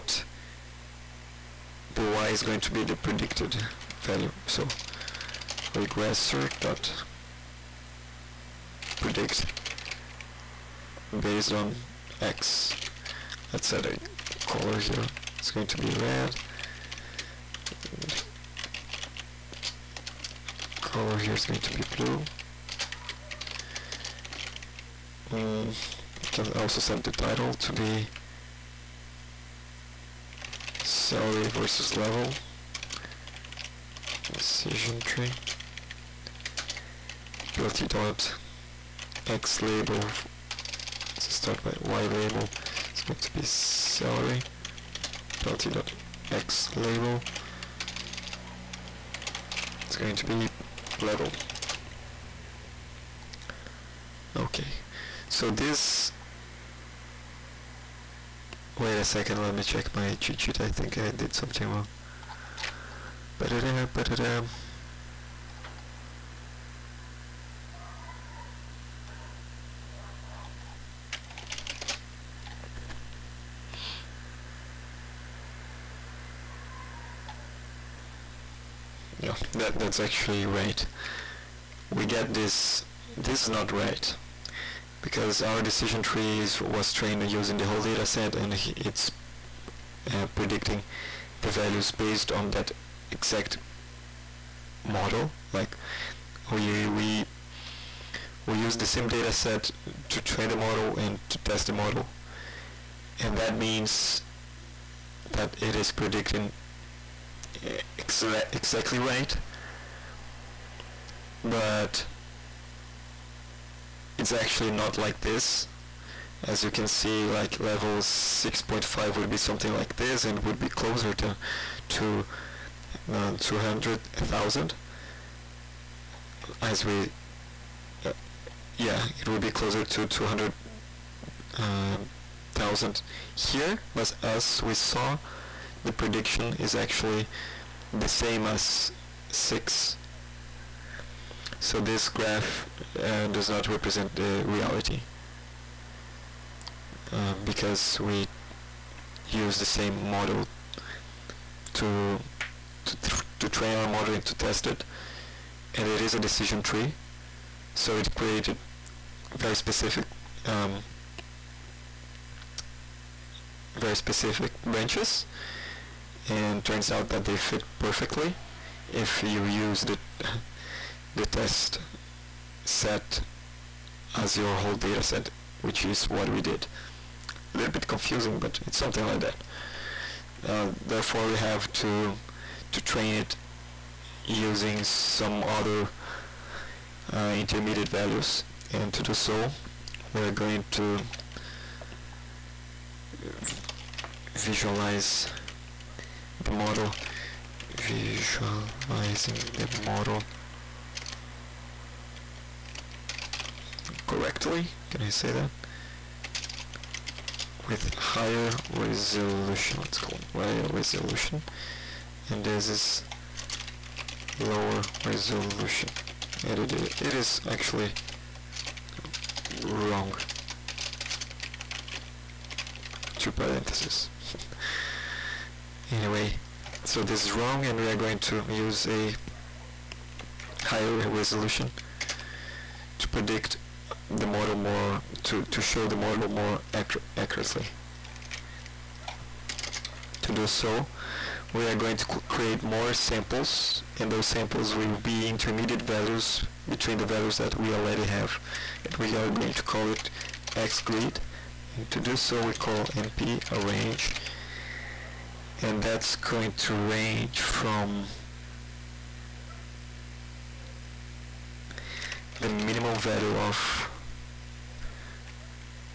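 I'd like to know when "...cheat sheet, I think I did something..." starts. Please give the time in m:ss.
1:00.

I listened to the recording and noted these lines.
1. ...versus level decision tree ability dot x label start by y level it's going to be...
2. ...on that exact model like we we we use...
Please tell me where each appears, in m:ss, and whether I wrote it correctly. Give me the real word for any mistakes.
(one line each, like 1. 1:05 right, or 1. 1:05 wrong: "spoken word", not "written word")
1. 0:31 wrong: "label", not "level"
2. 1:32 right.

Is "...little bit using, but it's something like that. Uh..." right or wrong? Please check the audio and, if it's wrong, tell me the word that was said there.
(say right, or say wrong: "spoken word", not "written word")
wrong: "confusing", not "using".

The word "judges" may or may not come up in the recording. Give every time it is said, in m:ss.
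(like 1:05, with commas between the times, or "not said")
not said.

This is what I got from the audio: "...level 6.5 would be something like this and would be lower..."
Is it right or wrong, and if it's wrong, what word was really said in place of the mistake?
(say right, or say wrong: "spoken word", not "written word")
wrong: "closer", not "lower".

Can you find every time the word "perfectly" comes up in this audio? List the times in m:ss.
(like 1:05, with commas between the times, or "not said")
2:47.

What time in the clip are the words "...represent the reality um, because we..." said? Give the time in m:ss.
2:23.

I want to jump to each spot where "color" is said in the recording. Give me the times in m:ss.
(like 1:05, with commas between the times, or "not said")
0:14, 0:20.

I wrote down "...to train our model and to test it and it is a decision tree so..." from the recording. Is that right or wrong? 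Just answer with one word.
right.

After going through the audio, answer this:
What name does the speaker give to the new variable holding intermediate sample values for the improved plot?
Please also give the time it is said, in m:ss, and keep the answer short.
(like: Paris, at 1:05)
xgrid, at 4:10.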